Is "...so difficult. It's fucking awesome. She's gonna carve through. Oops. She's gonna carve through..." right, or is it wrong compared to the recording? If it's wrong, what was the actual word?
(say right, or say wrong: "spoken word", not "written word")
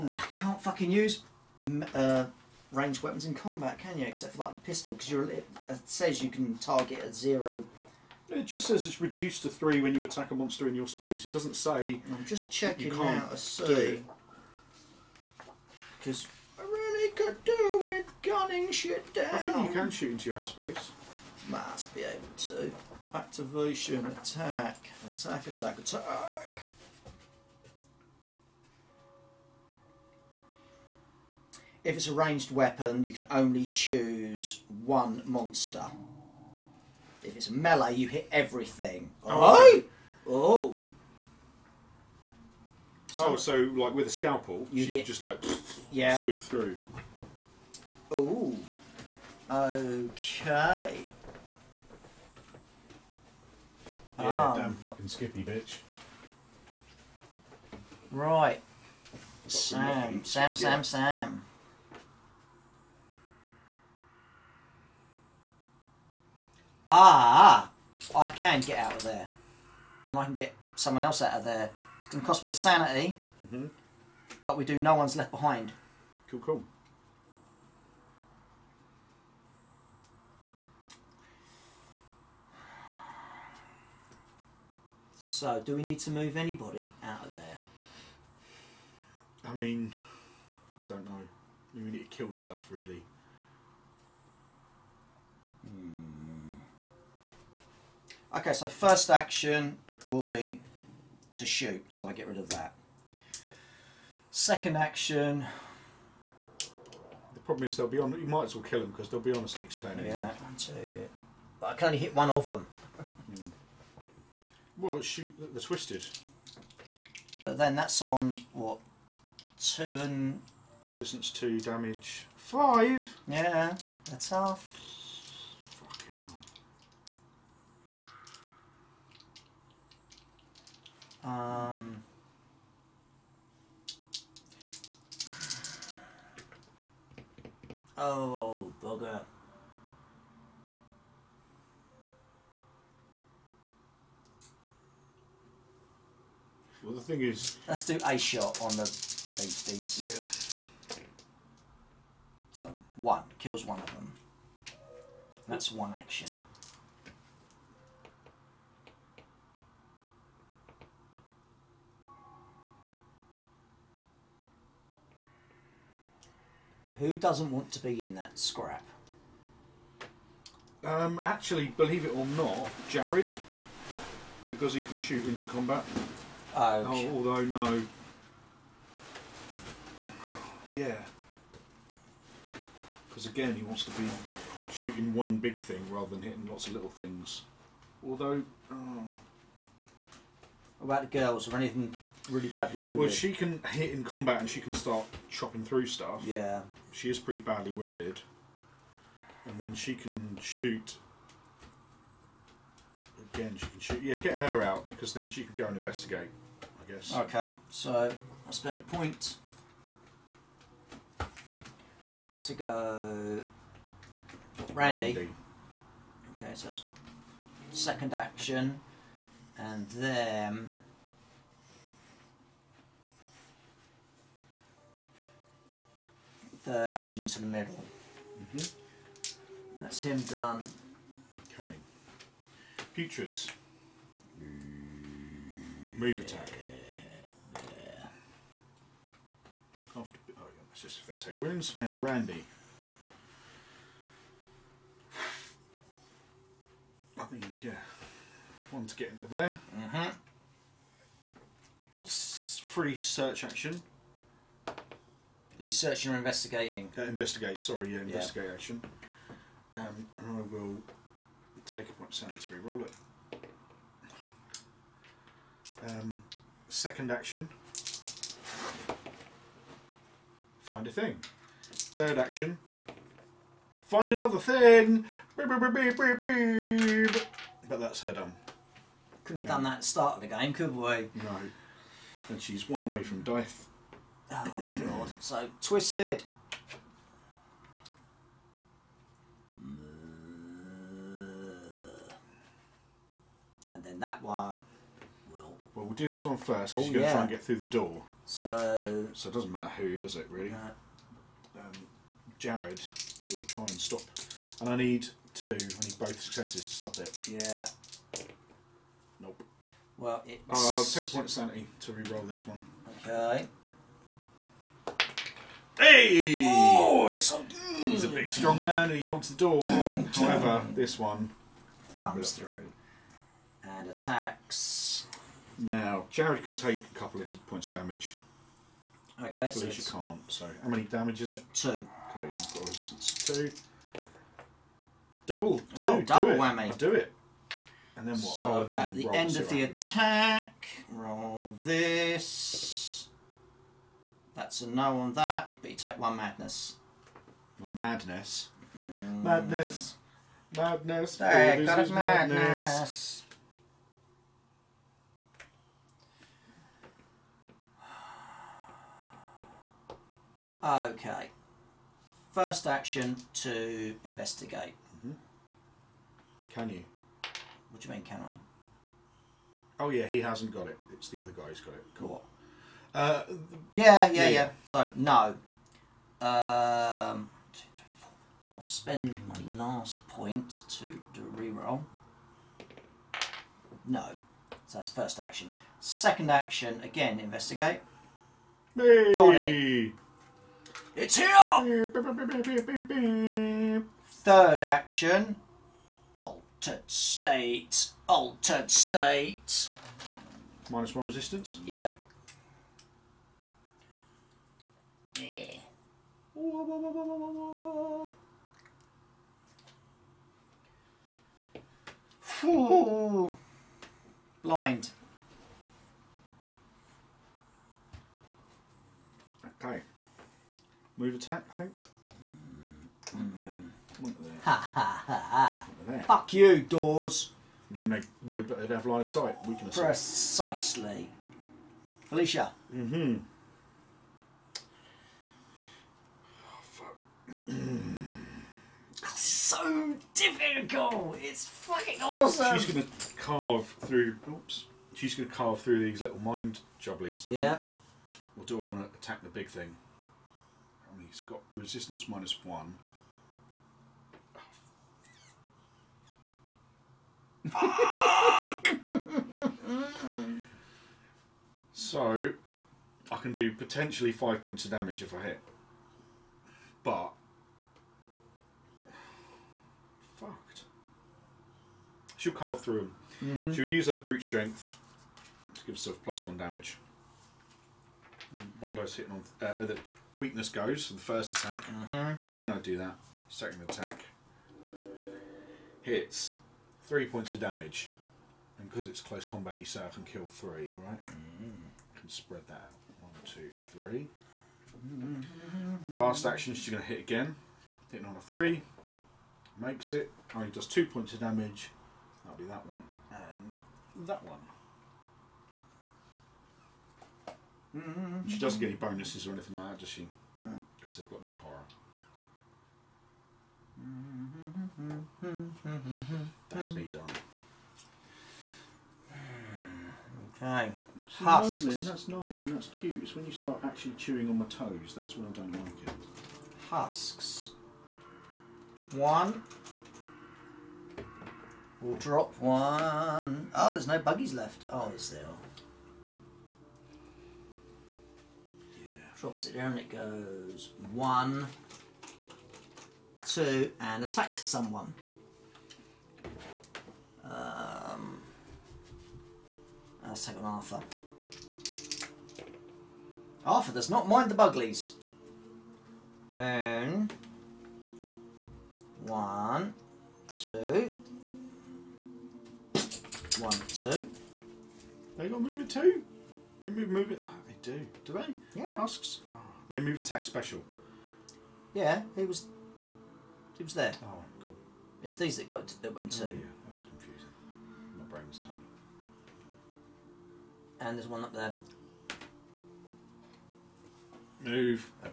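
right.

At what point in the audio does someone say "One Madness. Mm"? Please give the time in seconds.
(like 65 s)
347 s.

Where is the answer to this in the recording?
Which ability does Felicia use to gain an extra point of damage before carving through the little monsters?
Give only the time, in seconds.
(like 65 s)
473 s.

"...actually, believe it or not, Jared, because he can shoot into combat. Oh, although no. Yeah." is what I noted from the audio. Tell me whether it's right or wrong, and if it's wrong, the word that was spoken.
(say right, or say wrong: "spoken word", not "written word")
right.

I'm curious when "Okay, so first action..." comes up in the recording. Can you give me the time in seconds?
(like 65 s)
98 s.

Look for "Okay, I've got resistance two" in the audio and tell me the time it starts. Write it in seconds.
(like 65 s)
331 s.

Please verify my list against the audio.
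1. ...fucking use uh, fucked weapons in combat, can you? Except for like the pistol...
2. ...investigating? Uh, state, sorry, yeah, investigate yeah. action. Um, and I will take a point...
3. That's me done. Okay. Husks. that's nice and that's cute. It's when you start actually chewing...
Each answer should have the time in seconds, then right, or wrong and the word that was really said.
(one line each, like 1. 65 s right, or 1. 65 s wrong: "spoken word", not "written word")
1. 0 s wrong: "ranged", not "fucked"
2. 256 s wrong: "investigate", not "state"
3. 516 s right.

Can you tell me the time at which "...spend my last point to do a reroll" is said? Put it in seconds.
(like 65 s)
378 s.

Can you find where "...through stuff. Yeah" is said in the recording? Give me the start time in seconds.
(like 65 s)
195 s.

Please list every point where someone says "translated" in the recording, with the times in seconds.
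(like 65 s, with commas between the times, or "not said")
not said.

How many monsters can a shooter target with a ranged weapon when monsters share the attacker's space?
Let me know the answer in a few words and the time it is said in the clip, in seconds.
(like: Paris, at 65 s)
1, at 33 s.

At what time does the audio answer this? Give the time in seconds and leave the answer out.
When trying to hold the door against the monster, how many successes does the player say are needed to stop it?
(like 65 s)
305 s.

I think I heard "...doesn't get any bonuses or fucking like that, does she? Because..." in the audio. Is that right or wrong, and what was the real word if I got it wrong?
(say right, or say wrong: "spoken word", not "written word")
wrong: "anything", not "fucking".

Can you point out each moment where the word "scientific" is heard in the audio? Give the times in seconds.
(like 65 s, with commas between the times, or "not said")
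not said.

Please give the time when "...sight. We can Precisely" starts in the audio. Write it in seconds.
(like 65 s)
429 s.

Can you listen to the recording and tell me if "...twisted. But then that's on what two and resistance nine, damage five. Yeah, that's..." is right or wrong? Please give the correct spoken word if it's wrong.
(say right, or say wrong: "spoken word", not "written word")
wrong: "two", not "nine".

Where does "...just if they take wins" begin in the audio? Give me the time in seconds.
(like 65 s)
240 s.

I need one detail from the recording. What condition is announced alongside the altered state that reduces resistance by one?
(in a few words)
Blind.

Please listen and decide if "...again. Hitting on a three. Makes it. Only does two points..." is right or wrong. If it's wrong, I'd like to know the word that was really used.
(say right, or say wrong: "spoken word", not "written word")
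right.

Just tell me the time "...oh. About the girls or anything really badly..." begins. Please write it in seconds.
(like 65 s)
188 s.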